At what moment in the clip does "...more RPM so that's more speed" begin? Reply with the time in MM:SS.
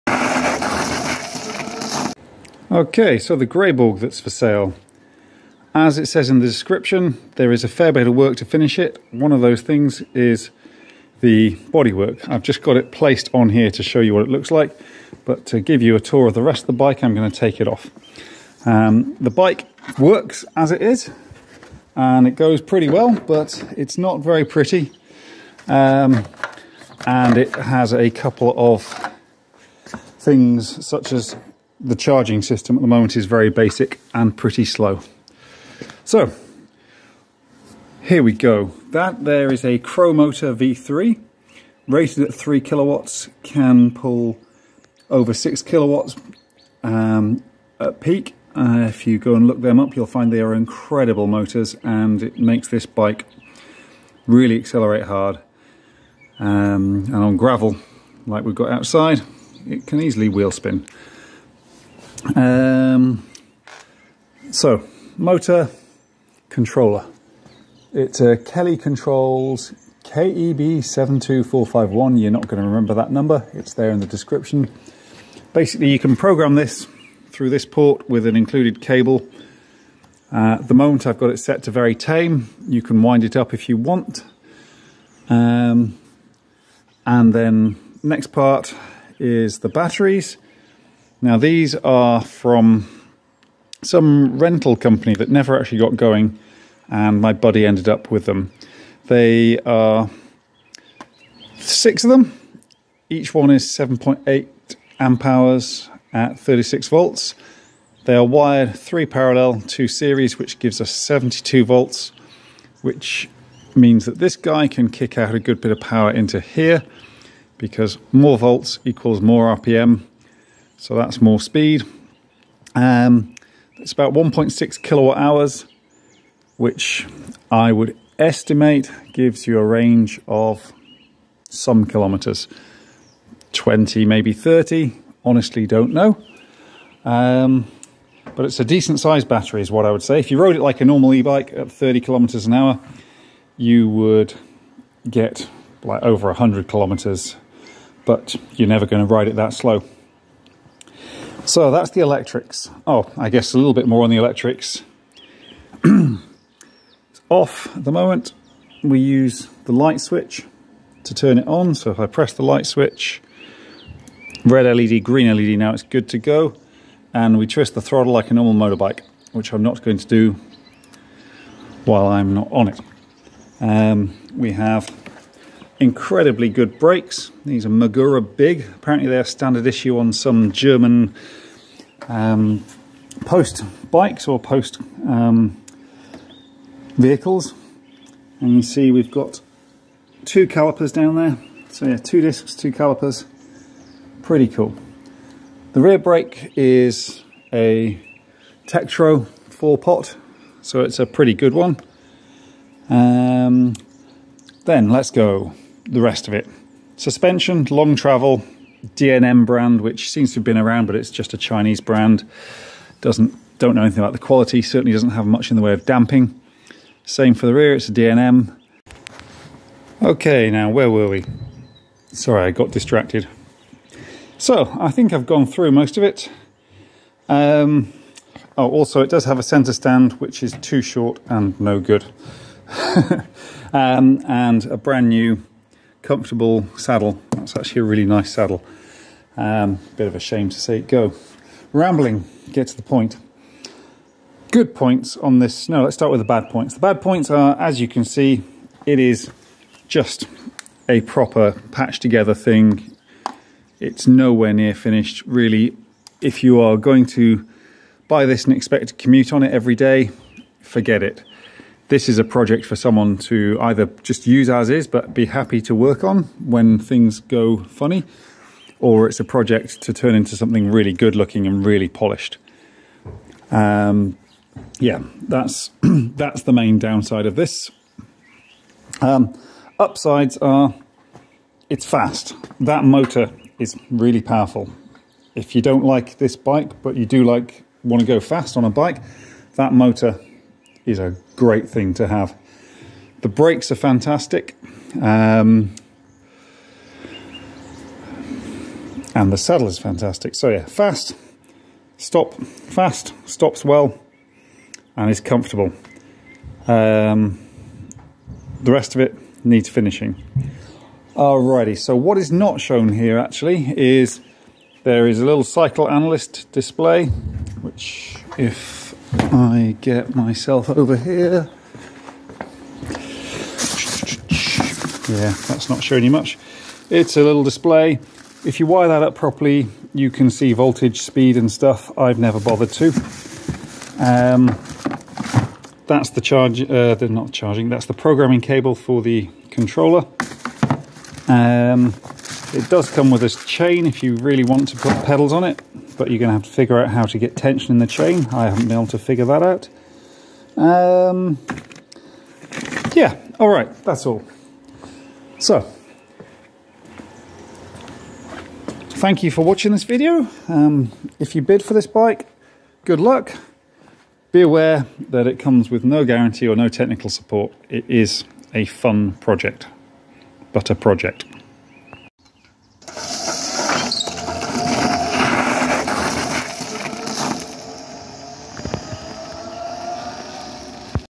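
01:59.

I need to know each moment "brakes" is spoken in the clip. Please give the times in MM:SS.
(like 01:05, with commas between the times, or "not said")
02:56, 03:15, 04:53.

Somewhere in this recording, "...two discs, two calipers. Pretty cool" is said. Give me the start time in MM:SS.
03:11.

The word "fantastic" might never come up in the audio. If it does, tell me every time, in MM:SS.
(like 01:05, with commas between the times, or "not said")
04:53, 04:59.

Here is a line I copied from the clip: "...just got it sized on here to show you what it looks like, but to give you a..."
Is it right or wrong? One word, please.
wrong.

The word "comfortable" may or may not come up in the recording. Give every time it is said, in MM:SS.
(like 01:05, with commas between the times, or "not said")
03:56, 05:05.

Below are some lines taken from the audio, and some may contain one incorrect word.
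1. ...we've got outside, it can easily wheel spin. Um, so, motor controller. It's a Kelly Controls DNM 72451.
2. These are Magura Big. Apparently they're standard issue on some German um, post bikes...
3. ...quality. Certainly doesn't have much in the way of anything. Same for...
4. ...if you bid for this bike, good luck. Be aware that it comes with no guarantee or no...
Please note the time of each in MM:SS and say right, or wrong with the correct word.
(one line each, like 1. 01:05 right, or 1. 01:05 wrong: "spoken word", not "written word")
1. 00:58 wrong: "KEB", not "DNM"
2. 02:57 right
3. 03:34 wrong: "damping", not "anything"
4. 06:01 right.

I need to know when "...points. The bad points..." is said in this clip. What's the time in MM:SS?
04:06.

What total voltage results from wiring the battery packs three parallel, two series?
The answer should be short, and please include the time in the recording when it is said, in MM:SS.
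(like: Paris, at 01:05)
72 volts, at 01:50.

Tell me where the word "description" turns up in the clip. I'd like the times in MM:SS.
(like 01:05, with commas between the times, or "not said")
00:06, 01:14.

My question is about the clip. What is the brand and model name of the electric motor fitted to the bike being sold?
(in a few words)
Cromotor V3.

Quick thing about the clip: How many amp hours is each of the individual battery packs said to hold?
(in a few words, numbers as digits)
7.8 amp hours.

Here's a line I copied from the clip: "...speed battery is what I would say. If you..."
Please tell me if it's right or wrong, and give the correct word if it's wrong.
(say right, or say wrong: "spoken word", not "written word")
wrong: "sized", not "speed".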